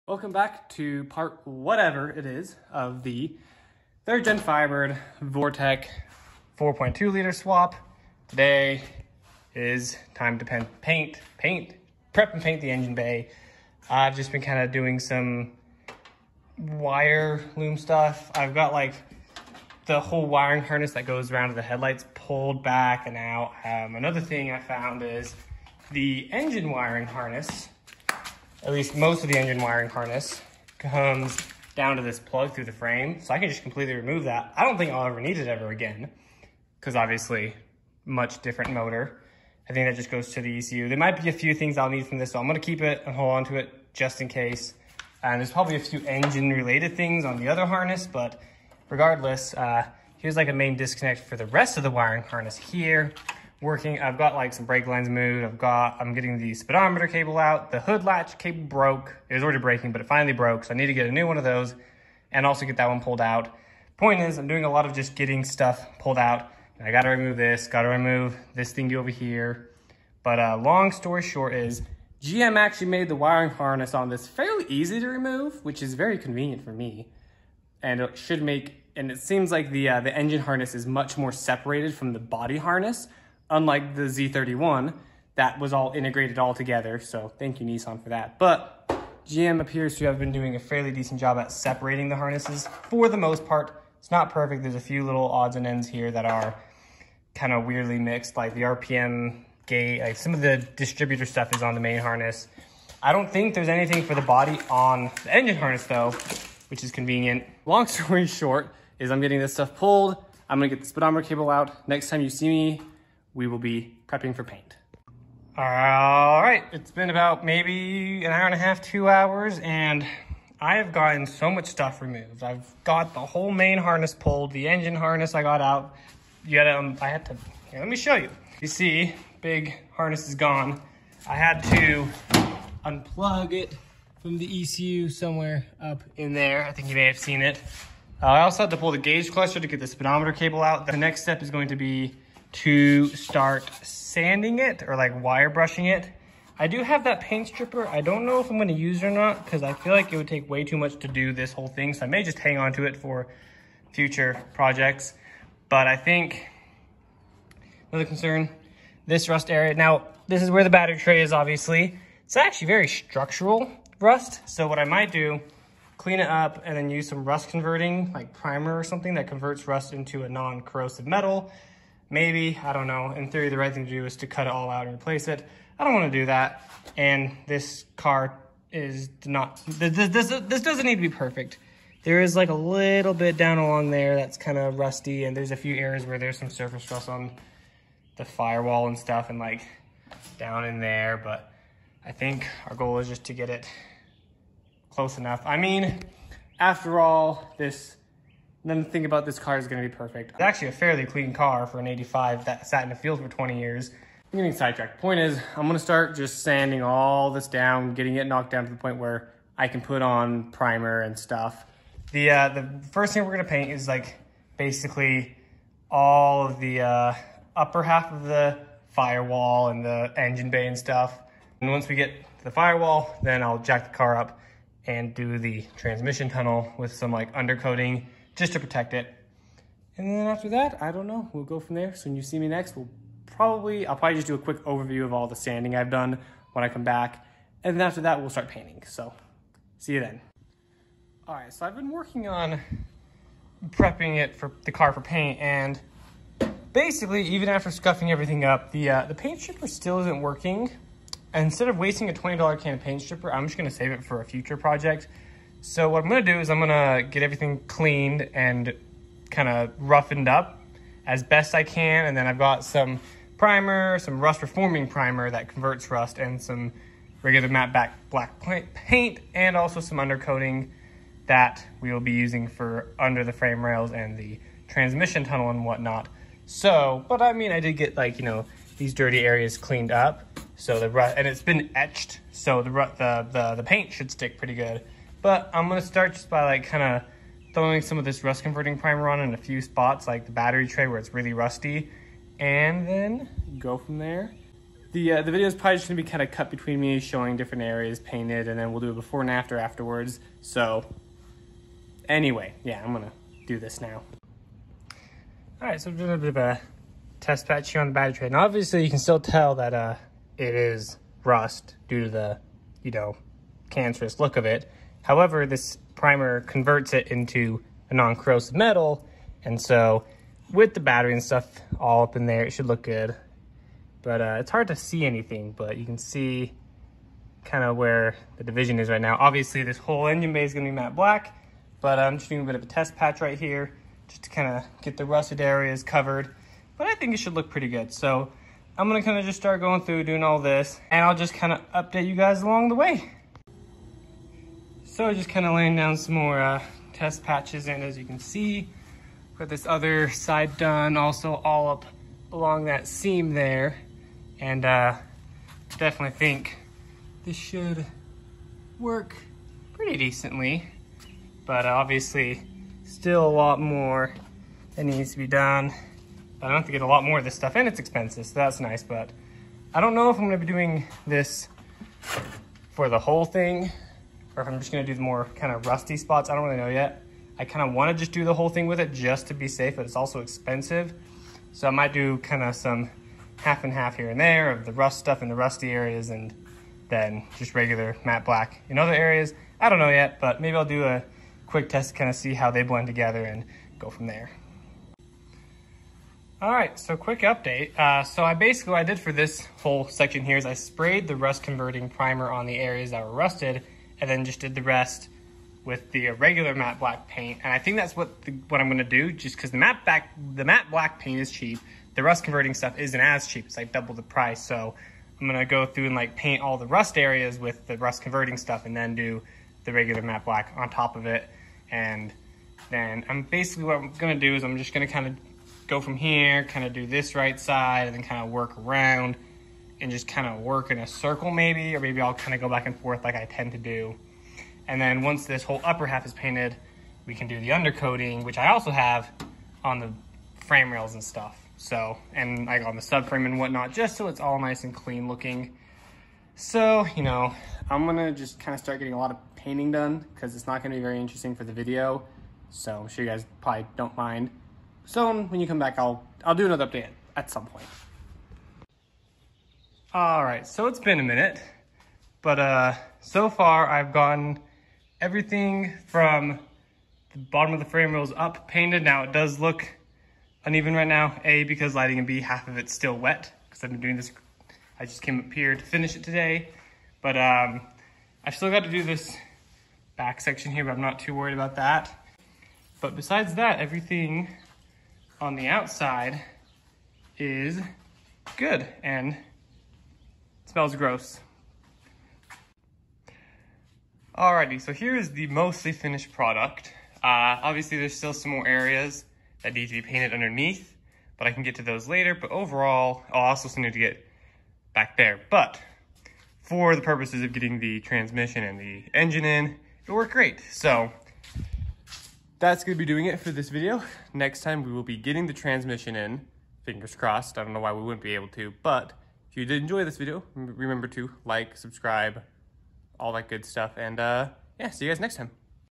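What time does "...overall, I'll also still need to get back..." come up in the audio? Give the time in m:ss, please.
8:22.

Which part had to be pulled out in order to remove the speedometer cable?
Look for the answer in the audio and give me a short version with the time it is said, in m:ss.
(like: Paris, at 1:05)
gauge cluster, at 2:18.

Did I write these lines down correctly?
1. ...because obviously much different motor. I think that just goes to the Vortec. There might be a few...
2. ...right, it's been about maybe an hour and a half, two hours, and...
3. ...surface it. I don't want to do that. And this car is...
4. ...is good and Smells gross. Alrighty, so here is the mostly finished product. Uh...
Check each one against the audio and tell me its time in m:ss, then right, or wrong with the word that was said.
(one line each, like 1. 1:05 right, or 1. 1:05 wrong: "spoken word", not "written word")
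1. 0:36 wrong: "ECU", not "Vortec"
2. 1:55 right
3. 2:54 wrong: "replace", not "surface"
4. 8:07 right.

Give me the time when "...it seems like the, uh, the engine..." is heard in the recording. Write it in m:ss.
1:19.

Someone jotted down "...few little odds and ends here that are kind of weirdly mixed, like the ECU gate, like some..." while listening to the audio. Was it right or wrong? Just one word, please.
wrong.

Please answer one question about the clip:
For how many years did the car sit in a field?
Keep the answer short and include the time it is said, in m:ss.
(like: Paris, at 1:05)
20 years, at 3:23.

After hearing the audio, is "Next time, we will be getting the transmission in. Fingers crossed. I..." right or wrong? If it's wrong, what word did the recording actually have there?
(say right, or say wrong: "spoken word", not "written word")
right.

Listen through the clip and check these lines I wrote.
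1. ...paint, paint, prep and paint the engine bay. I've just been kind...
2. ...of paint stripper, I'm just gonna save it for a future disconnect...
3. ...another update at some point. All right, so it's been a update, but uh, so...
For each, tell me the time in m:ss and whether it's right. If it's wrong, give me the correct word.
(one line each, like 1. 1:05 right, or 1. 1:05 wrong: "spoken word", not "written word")
1. 0:10 right
2. 4:12 wrong: "project", not "disconnect"
3. 7:36 wrong: "minute", not "update".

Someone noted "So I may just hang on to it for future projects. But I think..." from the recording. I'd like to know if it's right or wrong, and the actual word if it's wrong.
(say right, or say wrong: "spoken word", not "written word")
right.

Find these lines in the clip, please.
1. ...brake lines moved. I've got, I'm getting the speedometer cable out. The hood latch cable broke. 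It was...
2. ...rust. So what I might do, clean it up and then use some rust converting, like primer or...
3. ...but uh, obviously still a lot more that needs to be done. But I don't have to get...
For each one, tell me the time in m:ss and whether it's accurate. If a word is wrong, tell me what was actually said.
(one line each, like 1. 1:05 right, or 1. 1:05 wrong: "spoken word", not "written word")
1. 0:54 right
2. 2:43 right
3. 6:01 right.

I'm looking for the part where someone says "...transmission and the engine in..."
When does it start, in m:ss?
8:27.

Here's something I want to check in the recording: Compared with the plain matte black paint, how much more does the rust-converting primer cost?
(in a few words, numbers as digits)
double the price.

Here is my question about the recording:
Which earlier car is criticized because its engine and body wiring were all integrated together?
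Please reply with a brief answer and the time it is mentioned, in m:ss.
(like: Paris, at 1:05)
Z31, at 1:24.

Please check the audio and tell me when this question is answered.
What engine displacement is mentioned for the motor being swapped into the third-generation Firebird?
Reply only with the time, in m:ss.
0:06.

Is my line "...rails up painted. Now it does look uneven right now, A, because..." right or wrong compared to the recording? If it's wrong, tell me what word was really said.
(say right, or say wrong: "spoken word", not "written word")
right.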